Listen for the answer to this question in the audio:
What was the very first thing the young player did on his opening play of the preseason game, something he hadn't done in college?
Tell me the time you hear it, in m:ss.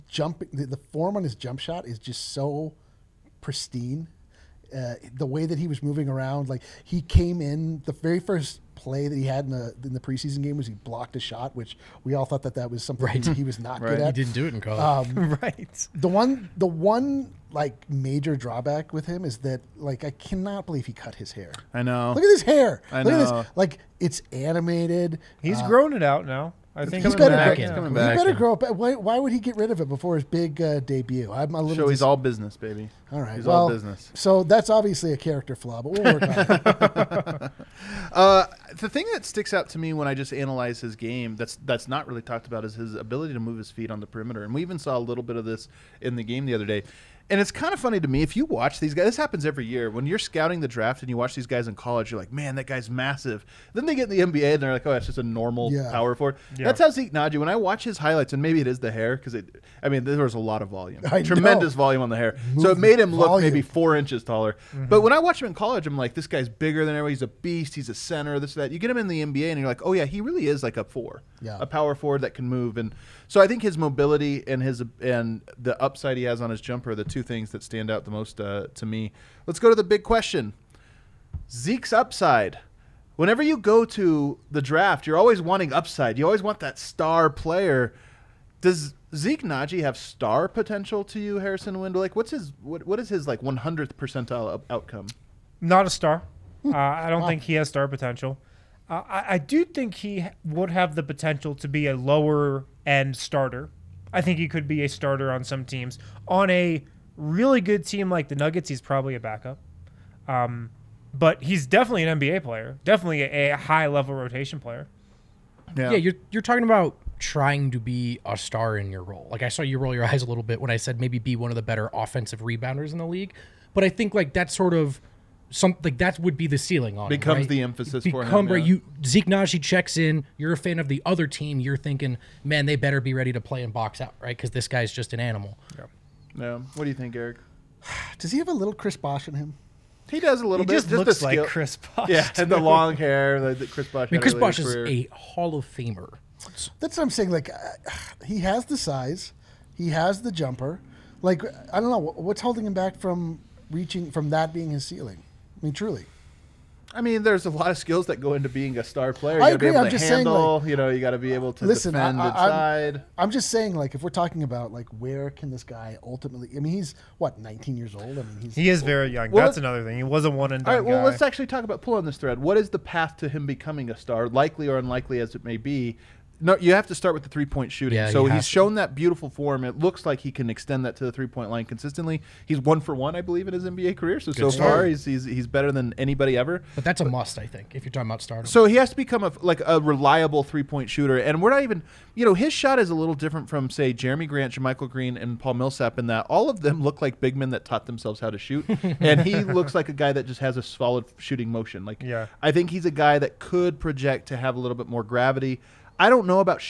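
0:10.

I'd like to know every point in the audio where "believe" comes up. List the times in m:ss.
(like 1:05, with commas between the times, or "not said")
0:20, 3:03.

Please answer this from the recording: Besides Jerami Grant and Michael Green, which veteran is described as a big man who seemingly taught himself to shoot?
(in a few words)
Paul Millsap.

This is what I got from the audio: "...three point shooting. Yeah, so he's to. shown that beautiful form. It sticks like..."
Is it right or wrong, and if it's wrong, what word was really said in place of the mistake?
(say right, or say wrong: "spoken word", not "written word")
wrong: "looks", not "sticks".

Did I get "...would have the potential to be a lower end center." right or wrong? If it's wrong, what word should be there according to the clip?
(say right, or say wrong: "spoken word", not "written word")
wrong: "starter", not "center".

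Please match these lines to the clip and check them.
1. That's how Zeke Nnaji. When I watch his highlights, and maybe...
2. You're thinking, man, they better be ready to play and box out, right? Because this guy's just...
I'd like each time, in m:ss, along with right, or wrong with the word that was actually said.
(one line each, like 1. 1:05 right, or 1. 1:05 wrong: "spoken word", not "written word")
1. 0:56 right
2. 2:11 right.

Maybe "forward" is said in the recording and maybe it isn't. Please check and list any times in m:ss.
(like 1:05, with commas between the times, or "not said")
0:56, 1:11.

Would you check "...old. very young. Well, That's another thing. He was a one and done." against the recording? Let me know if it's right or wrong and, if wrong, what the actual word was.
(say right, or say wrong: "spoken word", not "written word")
right.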